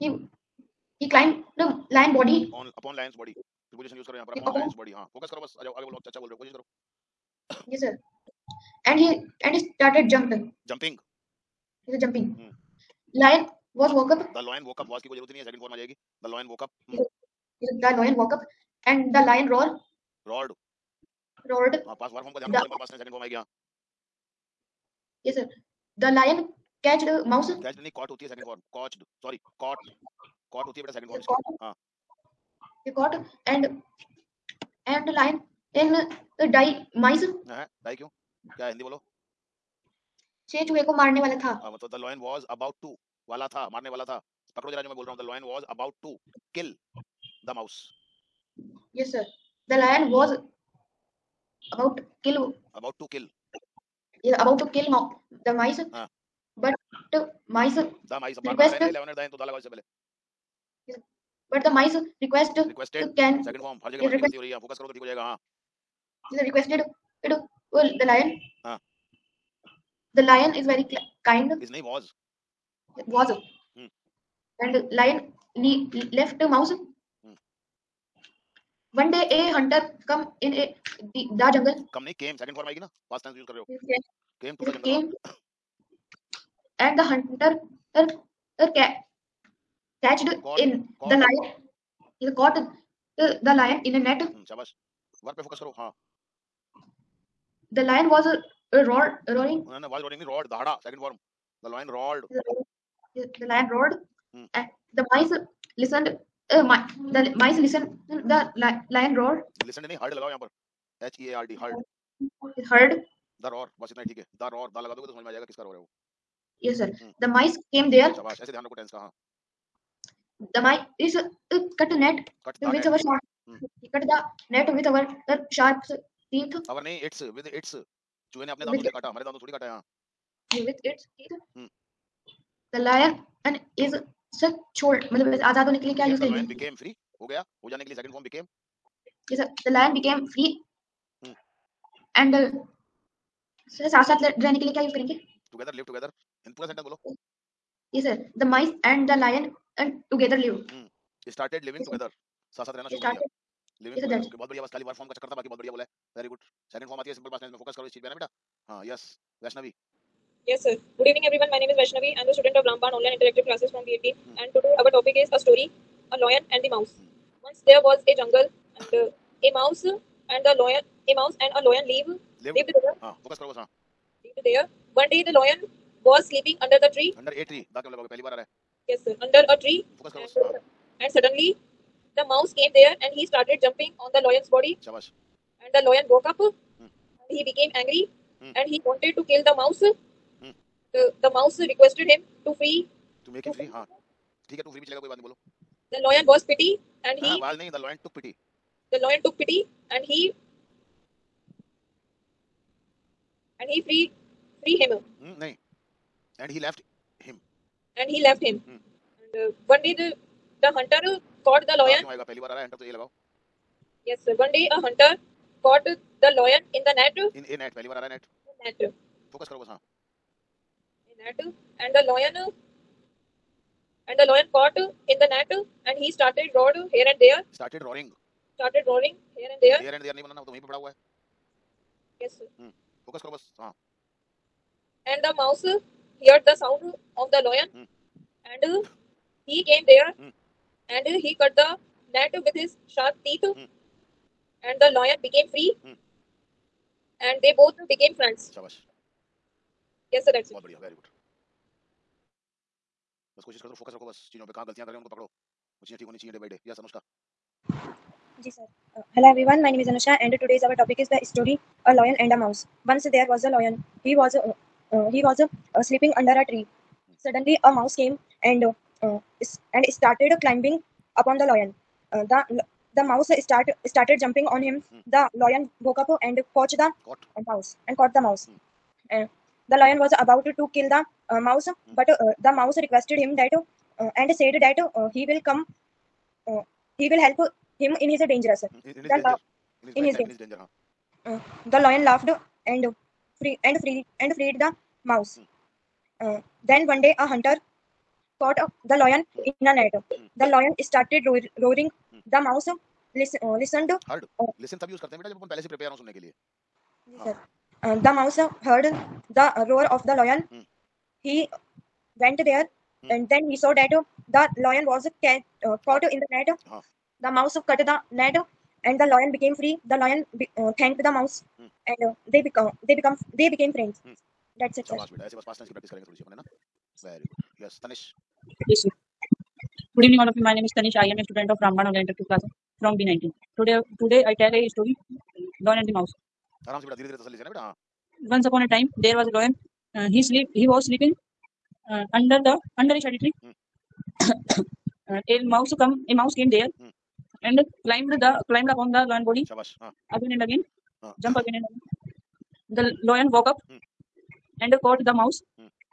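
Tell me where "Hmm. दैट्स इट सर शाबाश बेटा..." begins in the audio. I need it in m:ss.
5:24.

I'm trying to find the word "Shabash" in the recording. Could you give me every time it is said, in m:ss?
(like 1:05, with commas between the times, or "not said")
4:08, 5:49.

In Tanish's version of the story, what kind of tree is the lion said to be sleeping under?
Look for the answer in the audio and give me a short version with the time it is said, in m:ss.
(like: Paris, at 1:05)
shady tree, at 5:42.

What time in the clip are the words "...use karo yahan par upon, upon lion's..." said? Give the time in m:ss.
0:03.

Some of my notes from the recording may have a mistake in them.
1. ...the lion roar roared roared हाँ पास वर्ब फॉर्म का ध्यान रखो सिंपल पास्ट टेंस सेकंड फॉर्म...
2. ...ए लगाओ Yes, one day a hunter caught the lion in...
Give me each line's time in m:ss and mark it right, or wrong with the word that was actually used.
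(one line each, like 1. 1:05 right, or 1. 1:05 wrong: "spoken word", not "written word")
1. 0:19 right
2. 3:32 right.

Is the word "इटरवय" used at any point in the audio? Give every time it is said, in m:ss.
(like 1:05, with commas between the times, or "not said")
5:32.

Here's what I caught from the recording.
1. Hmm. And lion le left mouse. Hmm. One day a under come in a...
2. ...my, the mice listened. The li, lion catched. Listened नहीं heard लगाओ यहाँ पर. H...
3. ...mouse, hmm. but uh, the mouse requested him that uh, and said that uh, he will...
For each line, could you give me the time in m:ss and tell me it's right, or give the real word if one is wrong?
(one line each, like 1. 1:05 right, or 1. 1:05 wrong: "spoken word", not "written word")
1. 1:13 wrong: "hunter", not "under"
2. 1:46 wrong: "roared", not "catched"
3. 4:41 right.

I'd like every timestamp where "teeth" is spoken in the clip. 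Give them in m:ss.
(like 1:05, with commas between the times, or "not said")
2:11, 4:03.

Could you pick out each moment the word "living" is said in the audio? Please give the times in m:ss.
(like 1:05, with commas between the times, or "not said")
2:31.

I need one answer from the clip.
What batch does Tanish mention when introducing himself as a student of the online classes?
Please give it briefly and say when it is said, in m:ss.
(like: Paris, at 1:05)
B19, at 5:32.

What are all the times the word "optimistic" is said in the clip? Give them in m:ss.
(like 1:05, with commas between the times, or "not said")
not said.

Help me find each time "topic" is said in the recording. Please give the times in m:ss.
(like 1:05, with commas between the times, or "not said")
2:44, 4:20.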